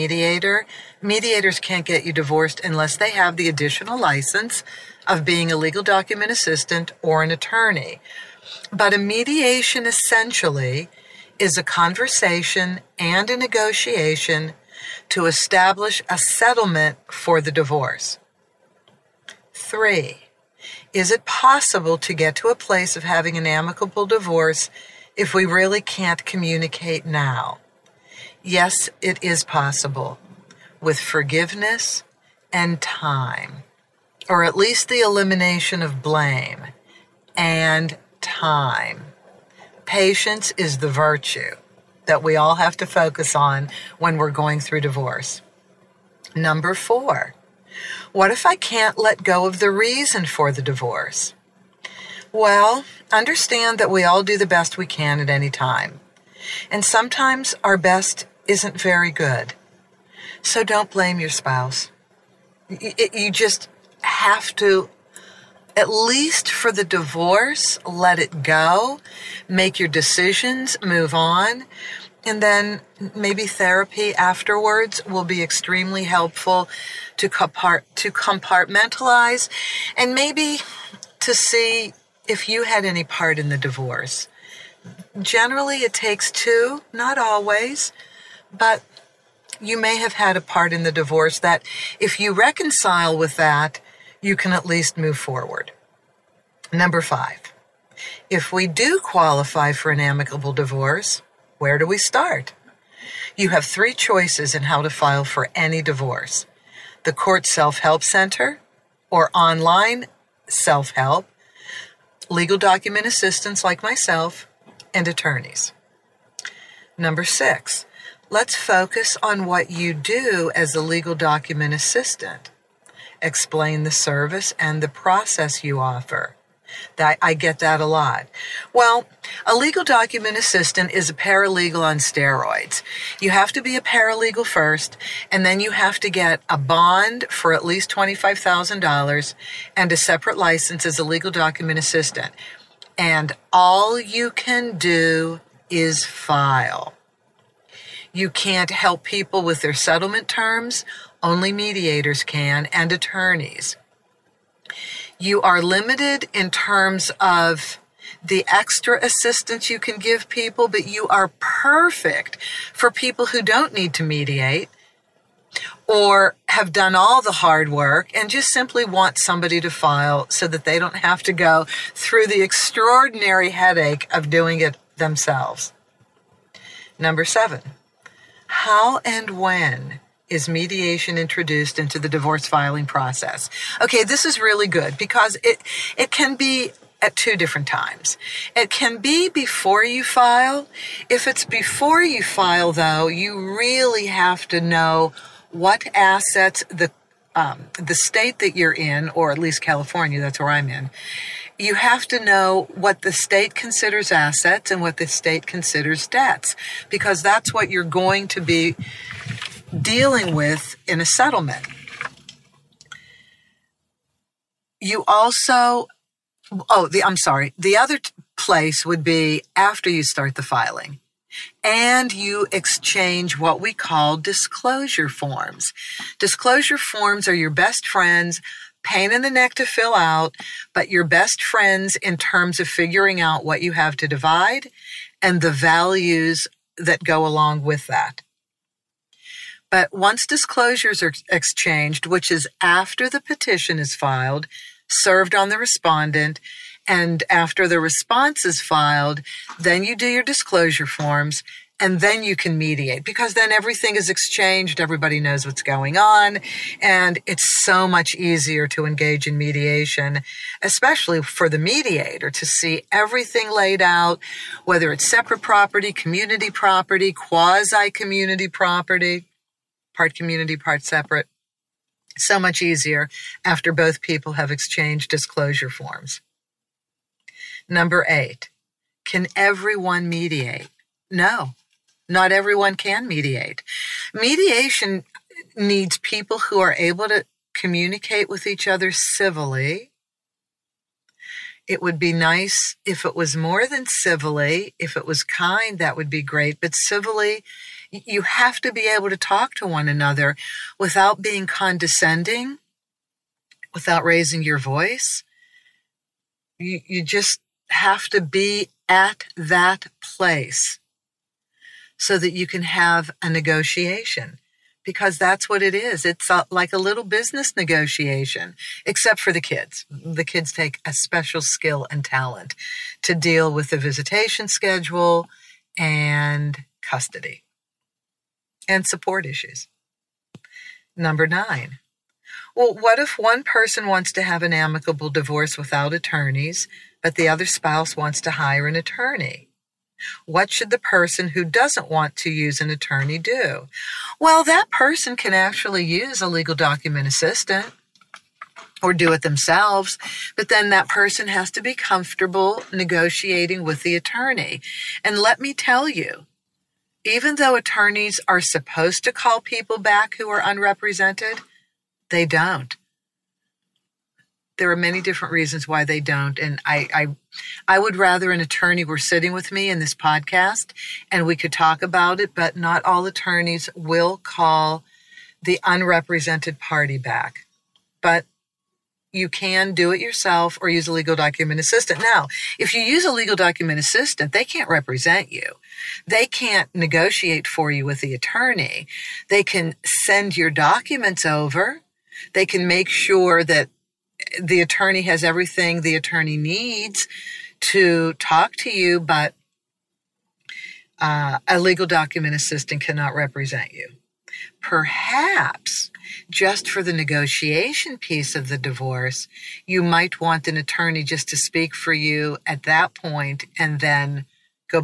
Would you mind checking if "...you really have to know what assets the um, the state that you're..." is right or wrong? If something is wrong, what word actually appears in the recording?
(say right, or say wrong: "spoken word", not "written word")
right.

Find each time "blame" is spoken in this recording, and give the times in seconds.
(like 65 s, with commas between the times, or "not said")
36 s, 60 s.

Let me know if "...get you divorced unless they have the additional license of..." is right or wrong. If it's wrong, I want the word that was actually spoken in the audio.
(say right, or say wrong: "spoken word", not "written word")
right.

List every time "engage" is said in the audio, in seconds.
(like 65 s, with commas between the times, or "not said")
258 s.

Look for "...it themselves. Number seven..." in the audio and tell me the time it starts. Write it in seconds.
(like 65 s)
174 s.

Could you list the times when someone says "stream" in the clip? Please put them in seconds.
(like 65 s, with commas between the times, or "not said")
not said.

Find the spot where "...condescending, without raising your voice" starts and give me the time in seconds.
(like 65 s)
301 s.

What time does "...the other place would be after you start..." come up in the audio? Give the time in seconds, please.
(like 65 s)
217 s.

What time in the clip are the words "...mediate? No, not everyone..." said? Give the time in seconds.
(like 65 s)
280 s.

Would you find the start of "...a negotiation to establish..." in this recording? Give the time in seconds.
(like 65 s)
13 s.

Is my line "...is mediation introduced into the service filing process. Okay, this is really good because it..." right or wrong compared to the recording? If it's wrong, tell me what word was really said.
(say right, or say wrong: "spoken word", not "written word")
wrong: "divorce", not "service".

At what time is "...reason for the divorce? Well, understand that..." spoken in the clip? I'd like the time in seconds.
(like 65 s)
49 s.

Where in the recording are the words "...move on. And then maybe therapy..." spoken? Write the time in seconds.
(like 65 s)
70 s.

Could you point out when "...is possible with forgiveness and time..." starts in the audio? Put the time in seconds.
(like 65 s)
29 s.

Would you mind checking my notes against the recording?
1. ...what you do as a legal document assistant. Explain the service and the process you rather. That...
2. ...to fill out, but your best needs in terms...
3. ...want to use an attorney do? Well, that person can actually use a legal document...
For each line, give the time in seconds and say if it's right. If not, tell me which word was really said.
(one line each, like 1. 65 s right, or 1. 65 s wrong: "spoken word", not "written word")
1. 119 s wrong: "offer", not "rather"
2. 229 s wrong: "friends", not "needs"
3. 341 s right.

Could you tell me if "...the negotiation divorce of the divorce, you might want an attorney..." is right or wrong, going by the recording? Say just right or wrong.
wrong.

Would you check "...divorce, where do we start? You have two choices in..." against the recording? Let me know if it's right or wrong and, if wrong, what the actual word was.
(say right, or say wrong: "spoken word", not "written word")
wrong: "three", not "two".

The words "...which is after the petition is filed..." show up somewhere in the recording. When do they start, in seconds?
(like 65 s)
242 s.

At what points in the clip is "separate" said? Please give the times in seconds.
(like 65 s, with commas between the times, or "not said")
139 s, 265 s, 270 s.